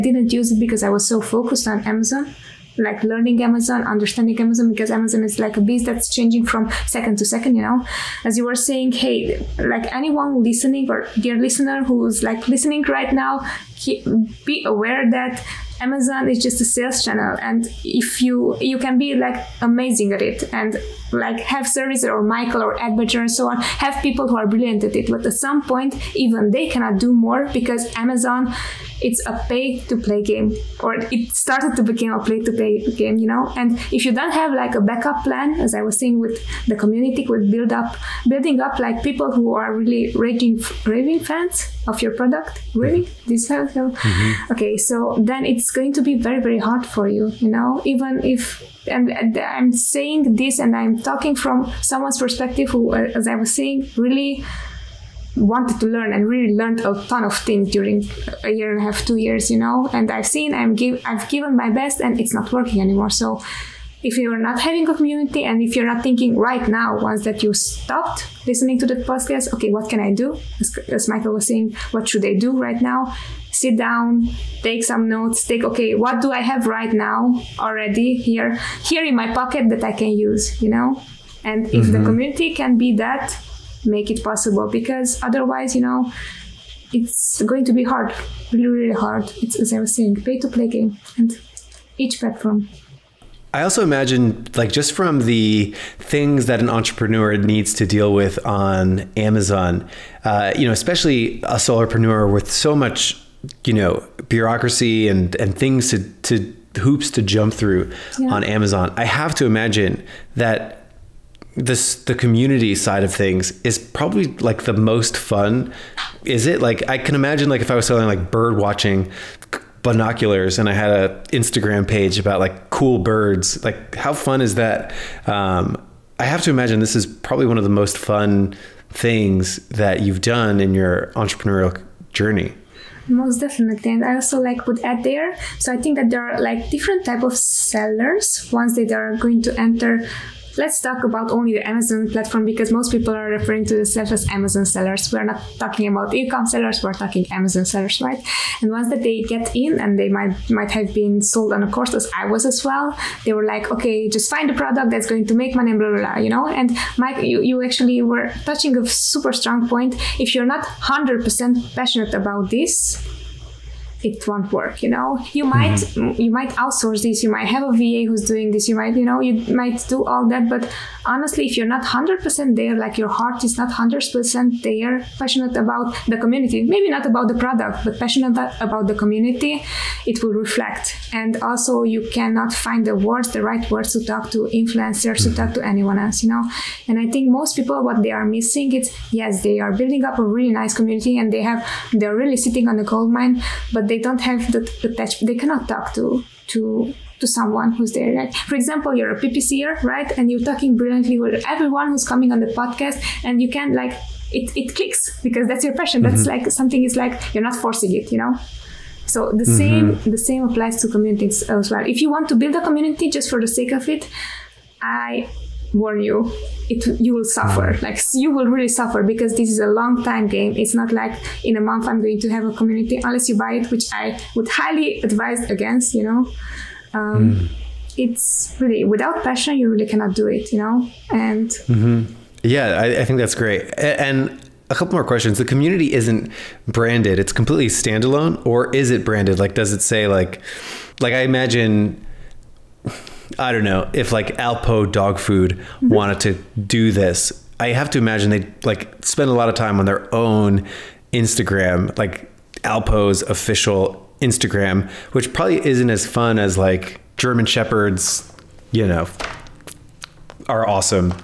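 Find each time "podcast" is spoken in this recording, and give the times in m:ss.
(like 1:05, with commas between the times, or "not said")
1:08, 3:22.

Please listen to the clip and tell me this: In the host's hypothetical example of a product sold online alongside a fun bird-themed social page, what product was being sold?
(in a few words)
bird watching binoculars.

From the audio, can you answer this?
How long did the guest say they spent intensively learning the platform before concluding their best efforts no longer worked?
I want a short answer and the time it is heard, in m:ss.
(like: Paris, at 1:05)
a year and a half, two years, at 0:58.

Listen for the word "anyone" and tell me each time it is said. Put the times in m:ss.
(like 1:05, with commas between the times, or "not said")
0:09, 3:05.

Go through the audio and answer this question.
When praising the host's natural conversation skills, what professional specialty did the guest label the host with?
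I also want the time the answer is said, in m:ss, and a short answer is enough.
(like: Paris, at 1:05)
PPCer, at 3:19.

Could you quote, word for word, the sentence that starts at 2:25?
We're not talking about e-com sellers, we're talking Amazon sellers, right?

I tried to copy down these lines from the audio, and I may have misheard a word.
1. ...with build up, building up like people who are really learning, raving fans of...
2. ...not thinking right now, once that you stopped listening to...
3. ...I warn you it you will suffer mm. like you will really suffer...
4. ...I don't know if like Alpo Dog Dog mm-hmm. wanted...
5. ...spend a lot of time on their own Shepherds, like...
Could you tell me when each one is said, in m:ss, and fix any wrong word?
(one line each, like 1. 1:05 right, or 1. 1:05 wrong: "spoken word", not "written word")
1. 0:37 wrong: "raging", not "learning"
2. 1:05 right
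3. 3:34 right
4. 4:03 wrong: "Food", not "Dog"
5. 4:09 wrong: "Instagram", not "Shepherds".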